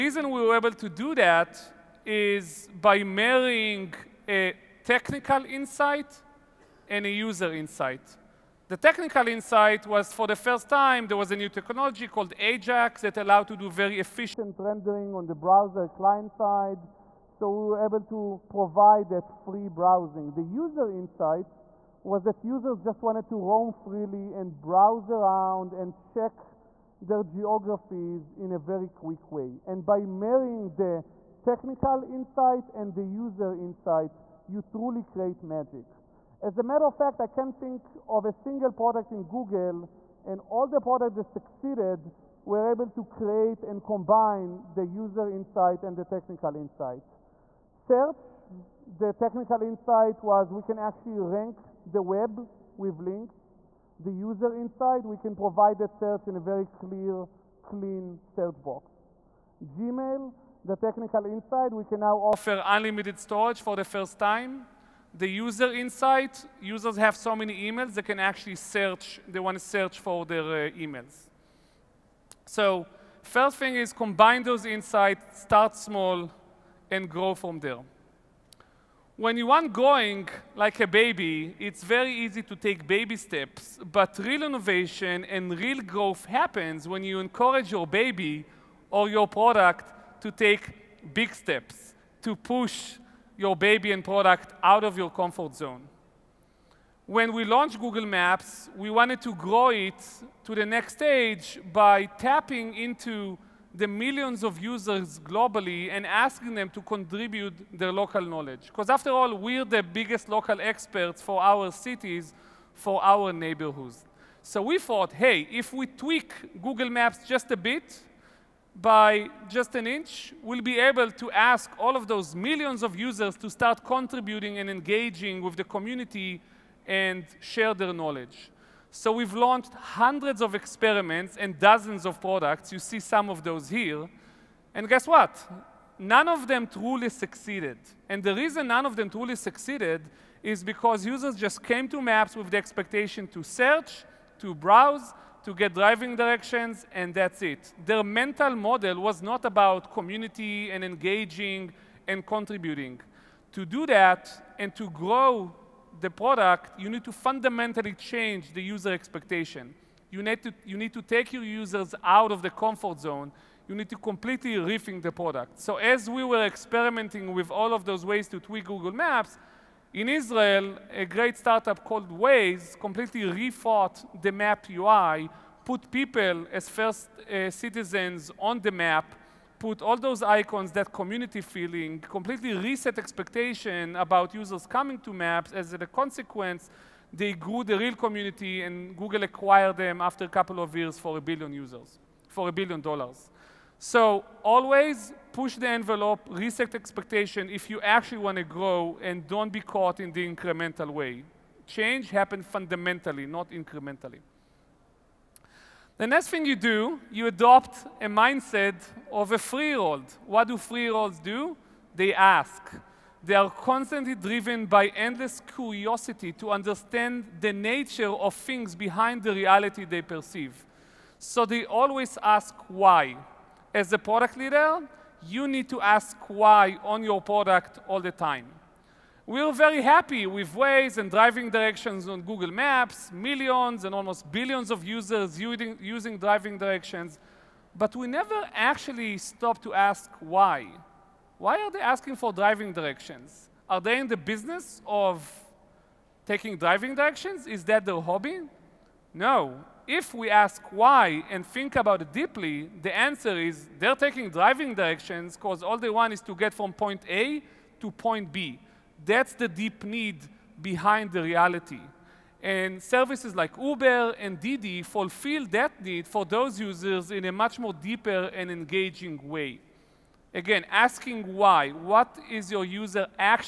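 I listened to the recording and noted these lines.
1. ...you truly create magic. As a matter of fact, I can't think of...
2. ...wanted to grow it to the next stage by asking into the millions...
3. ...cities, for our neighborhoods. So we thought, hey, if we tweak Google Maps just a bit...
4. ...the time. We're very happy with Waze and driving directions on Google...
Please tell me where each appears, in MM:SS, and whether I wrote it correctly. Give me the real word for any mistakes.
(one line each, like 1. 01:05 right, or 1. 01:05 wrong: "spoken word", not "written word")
1. 00:34 right
2. 01:38 wrong: "tapping", not "asking"
3. 01:51 right
4. 03:47 right.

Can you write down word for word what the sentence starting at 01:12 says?
So first thing is combine those insights, start small, and grow from there.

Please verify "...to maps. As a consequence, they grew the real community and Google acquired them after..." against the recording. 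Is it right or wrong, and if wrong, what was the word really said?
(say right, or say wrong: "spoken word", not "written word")
right.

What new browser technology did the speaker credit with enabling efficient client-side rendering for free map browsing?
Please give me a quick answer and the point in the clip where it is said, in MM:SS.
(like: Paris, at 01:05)
Ajax, at 00:12.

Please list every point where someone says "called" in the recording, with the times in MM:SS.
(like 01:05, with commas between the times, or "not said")
00:12, 02:51.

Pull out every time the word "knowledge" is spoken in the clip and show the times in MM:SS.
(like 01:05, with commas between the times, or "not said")
01:48, 02:07.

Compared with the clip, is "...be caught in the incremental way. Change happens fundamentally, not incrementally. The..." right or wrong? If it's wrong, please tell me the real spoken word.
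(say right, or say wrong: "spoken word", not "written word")
right.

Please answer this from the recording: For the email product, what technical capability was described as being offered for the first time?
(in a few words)
unlimited storage.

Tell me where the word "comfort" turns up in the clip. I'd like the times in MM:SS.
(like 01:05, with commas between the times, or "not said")
01:35, 02:42.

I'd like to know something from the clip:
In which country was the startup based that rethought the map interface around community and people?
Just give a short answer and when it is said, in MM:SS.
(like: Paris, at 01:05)
Israel, at 02:50.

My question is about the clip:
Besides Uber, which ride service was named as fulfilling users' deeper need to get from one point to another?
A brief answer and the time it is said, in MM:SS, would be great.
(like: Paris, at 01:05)
Didi, at 04:24.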